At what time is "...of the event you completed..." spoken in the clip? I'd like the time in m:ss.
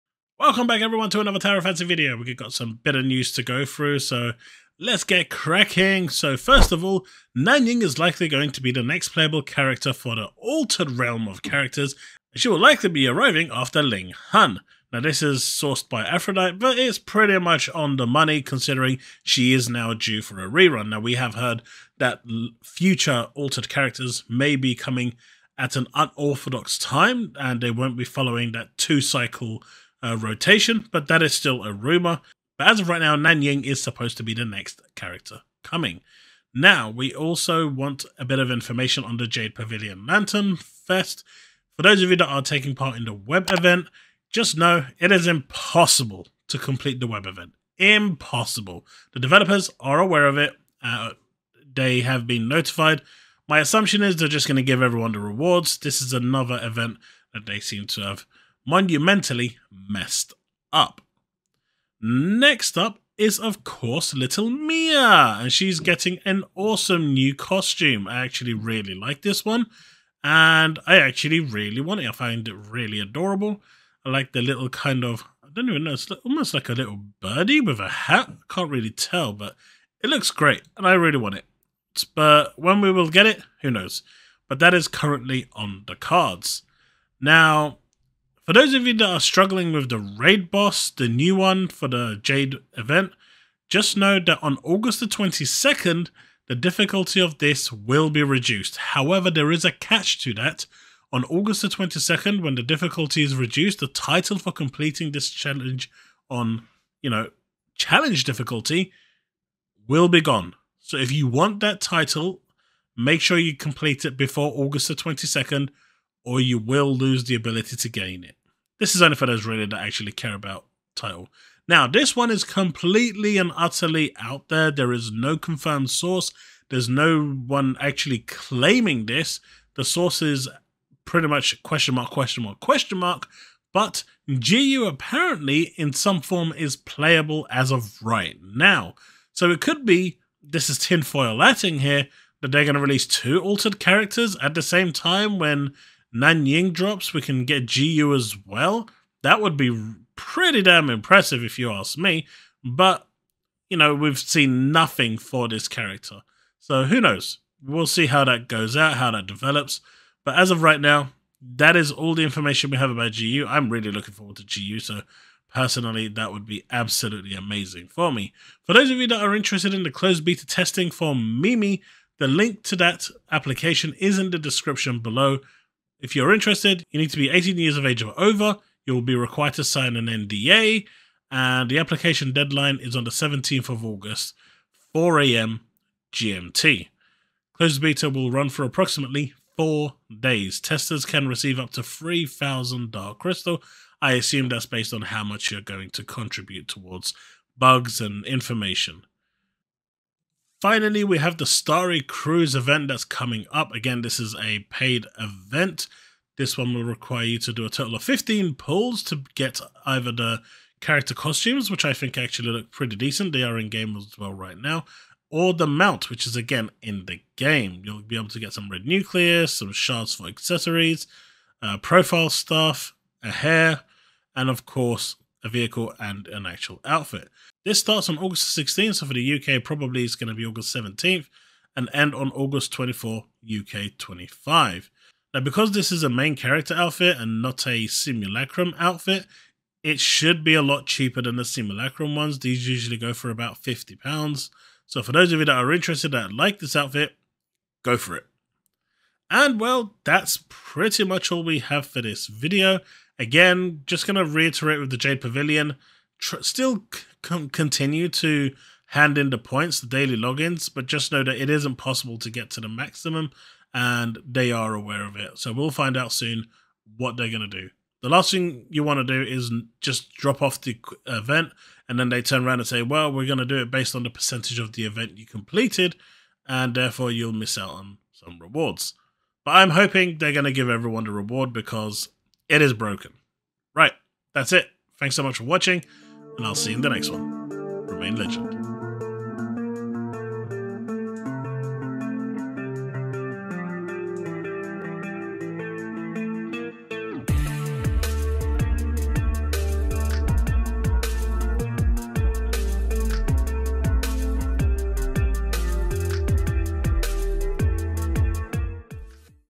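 4:34.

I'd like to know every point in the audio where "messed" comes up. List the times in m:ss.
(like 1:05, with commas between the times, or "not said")
0:59.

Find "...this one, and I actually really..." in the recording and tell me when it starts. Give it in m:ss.
1:09.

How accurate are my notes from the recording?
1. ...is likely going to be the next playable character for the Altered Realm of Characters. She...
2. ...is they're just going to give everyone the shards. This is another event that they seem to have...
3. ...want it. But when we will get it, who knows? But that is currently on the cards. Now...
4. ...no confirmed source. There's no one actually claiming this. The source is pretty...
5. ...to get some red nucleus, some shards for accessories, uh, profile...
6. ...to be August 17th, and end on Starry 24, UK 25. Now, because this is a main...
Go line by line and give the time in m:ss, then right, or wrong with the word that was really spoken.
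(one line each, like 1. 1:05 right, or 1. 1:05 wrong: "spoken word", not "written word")
1. 0:07 right
2. 0:54 wrong: "rewards", not "shards"
3. 1:21 right
4. 2:05 right
5. 3:38 right
6. 3:50 wrong: "August", not "Starry".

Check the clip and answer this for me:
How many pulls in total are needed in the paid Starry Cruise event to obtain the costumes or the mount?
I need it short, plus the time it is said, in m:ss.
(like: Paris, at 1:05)
15, at 3:28.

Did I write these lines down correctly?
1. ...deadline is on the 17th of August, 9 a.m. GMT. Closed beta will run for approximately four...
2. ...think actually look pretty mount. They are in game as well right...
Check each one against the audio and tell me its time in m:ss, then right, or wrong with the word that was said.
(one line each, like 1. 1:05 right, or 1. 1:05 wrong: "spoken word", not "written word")
1. 3:02 wrong: "4", not "9"
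2. 3:31 wrong: "decent", not "mount".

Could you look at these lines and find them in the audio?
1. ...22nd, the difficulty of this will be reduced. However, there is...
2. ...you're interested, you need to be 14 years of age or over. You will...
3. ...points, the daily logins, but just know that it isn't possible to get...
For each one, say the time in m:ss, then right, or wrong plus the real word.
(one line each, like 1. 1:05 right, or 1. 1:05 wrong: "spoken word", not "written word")
1. 1:35 right
2. 2:56 wrong: "18", not "14"
3. 4:19 right.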